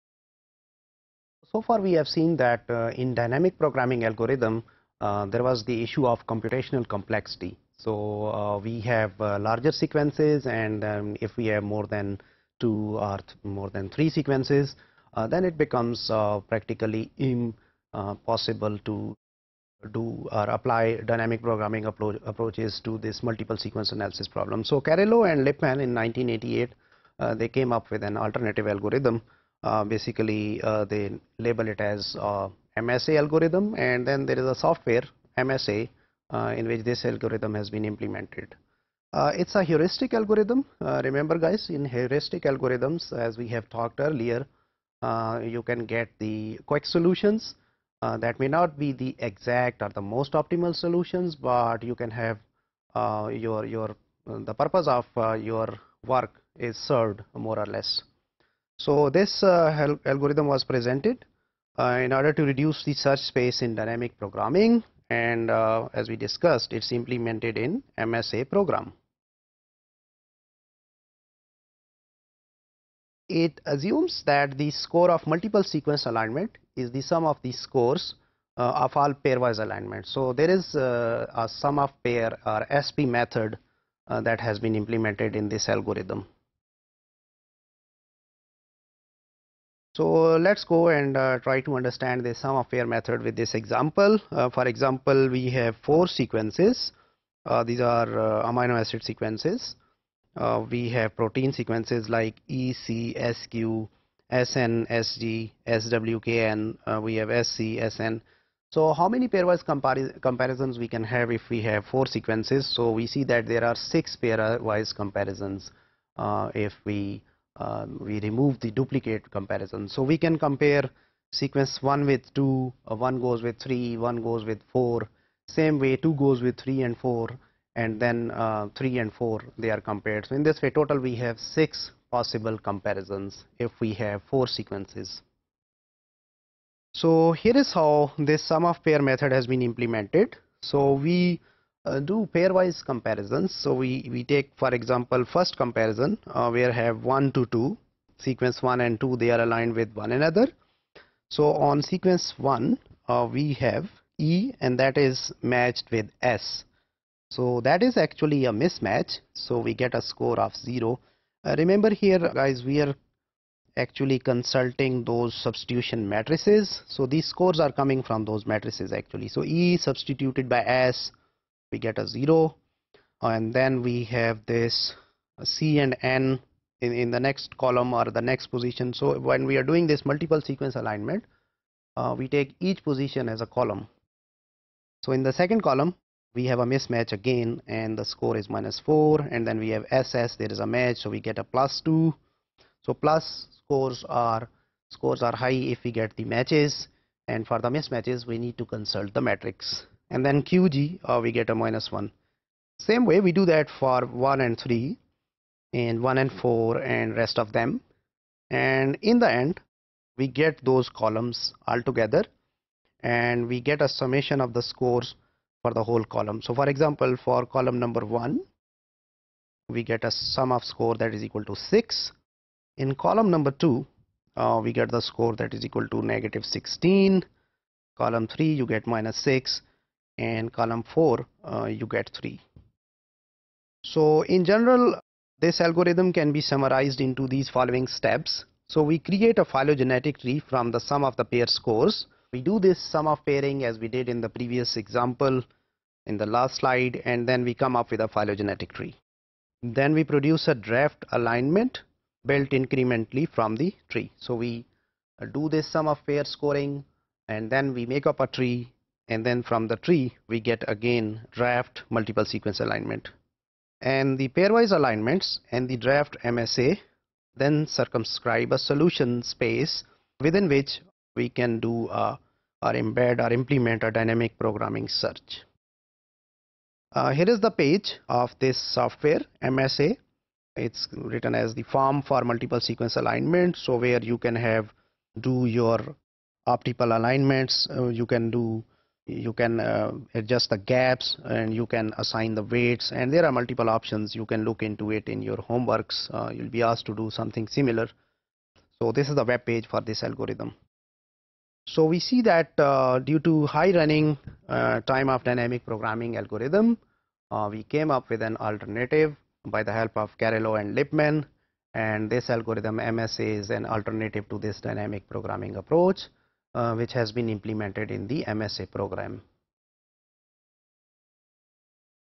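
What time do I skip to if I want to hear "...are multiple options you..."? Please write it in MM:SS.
04:53.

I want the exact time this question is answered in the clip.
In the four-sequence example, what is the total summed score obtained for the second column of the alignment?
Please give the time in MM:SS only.
03:46.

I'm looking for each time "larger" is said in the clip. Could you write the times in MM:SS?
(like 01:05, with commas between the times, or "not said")
00:09.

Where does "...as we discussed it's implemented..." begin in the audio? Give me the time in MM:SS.
01:05.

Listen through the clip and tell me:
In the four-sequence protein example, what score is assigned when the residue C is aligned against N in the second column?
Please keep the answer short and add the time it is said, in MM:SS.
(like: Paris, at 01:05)
-4, at 03:08.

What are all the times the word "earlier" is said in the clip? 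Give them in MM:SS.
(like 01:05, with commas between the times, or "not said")
00:43.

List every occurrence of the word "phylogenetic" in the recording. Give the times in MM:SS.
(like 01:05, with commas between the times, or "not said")
03:59, 04:08.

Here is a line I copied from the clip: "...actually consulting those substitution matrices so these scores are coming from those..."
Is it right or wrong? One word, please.
right.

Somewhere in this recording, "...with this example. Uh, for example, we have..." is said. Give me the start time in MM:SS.
01:33.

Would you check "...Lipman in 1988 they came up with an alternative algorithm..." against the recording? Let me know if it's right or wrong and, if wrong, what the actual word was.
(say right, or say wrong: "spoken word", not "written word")
right.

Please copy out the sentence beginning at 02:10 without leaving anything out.
So in this way total we have 6 possible comparisons if we have 4 sequences.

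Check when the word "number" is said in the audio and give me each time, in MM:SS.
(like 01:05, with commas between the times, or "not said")
03:37, 03:43.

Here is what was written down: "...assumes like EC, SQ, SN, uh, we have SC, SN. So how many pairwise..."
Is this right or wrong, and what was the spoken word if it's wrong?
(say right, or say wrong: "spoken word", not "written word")
wrong: "sequences", not "assumes".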